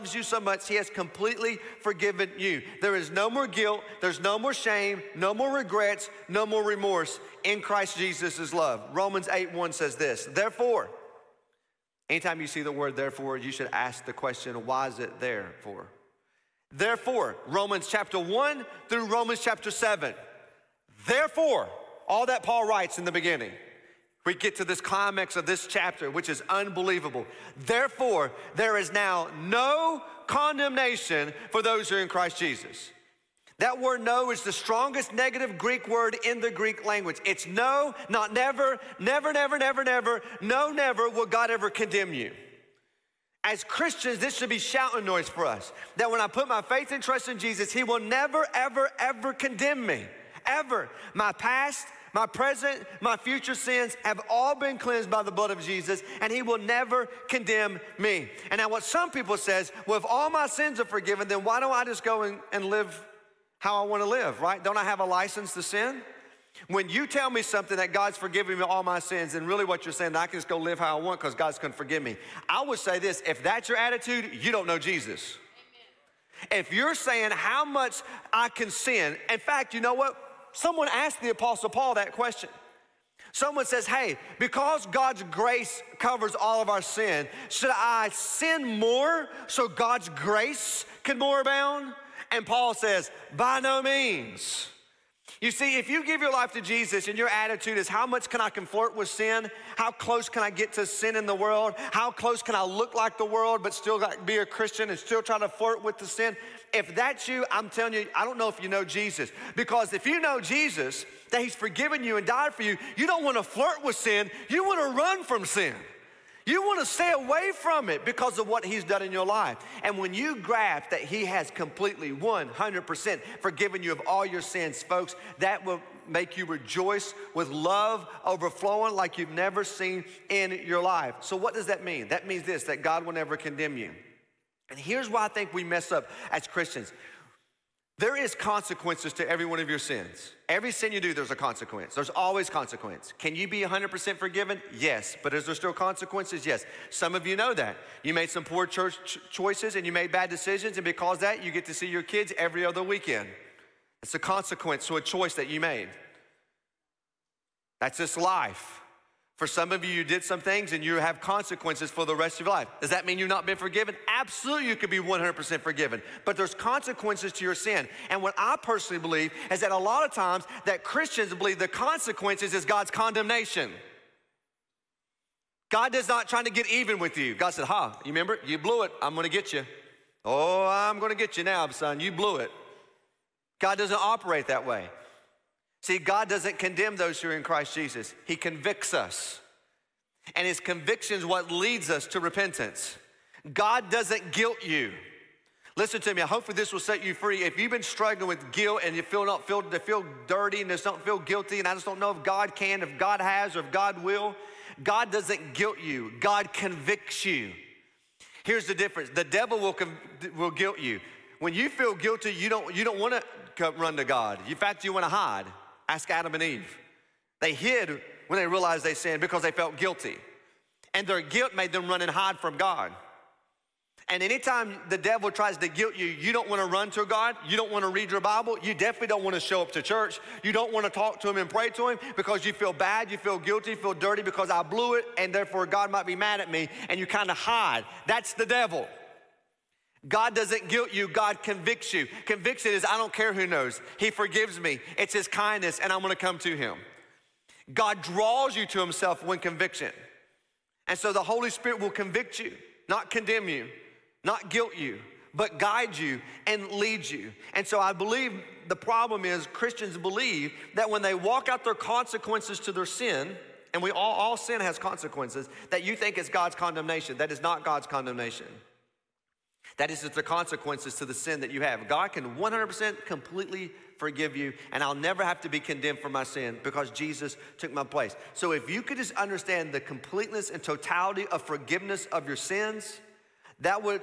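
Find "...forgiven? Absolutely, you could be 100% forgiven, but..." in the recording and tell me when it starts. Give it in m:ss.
2:43.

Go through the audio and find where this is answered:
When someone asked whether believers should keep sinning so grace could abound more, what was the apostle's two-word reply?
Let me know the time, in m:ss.
1:33.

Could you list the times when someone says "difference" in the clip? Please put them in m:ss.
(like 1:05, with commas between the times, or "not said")
3:28.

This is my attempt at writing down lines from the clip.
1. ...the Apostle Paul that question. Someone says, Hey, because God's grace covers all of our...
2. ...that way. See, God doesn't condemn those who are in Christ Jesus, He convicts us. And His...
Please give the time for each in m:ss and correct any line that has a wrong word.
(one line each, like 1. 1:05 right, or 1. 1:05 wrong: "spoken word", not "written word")
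1. 1:21 right
2. 3:04 right.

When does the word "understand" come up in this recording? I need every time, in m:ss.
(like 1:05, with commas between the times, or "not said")
4:39.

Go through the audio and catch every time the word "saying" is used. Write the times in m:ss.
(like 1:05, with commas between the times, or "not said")
1:09, 1:16.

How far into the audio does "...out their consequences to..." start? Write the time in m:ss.
4:21.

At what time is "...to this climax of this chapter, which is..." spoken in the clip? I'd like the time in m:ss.
0:24.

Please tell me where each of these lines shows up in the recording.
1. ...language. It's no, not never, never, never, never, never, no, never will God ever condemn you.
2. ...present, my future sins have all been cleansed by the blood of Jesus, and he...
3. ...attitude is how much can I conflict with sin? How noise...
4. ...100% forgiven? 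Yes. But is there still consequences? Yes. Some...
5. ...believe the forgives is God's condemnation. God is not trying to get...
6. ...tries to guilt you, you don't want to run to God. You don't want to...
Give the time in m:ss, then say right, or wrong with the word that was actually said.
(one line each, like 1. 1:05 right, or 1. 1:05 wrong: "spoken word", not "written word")
1. 0:36 right
2. 0:52 right
3. 1:37 wrong: "close", not "noise"
4. 2:23 right
5. 2:51 wrong: "consequences", not "forgives"
6. 3:45 right.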